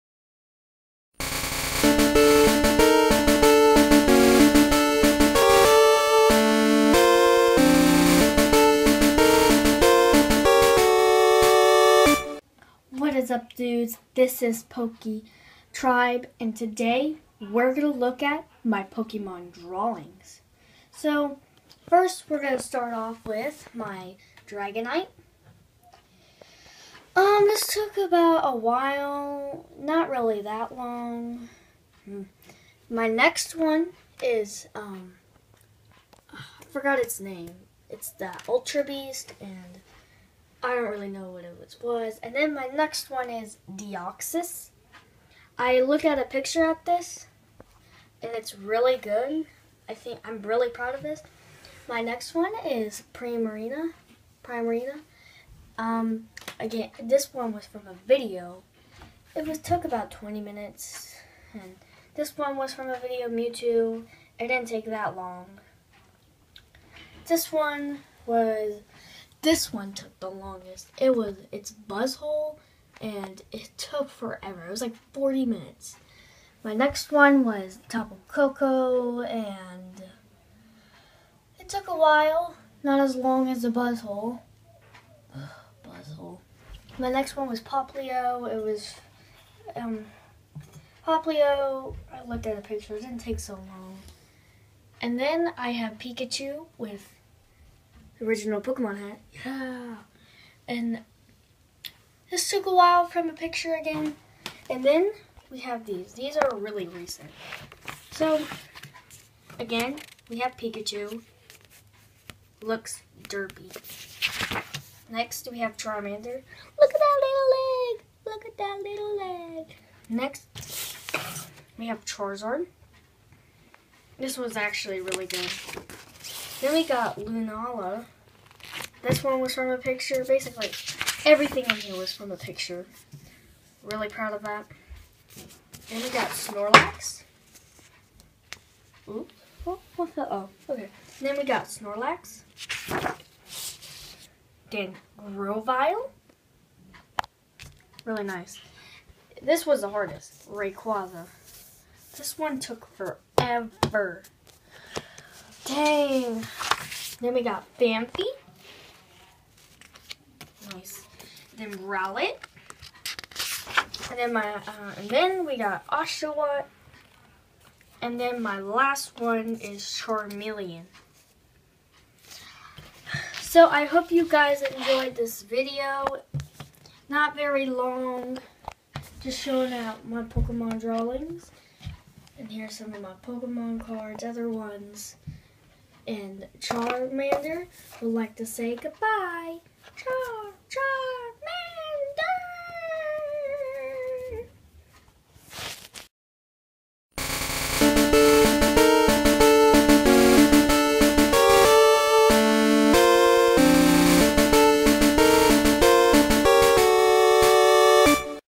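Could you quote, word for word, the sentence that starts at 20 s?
So, first we're going to start off with my Dragonite.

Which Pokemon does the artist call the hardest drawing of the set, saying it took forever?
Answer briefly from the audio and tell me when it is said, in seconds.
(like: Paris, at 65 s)
Rayquaza, at 150 s.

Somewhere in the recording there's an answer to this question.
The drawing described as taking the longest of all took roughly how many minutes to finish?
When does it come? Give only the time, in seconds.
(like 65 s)
75 s.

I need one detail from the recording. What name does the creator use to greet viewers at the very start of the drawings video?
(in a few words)
Pokey Tribe.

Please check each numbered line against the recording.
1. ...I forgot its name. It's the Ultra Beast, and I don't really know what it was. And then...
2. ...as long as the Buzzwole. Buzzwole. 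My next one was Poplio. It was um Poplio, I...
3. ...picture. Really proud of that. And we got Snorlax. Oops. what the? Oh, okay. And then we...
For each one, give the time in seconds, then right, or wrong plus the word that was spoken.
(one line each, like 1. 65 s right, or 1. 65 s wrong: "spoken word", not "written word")
1. 36 s right
2. 82 s right
3. 132 s right.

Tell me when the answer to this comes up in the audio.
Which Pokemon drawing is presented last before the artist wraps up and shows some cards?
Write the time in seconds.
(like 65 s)
169 s.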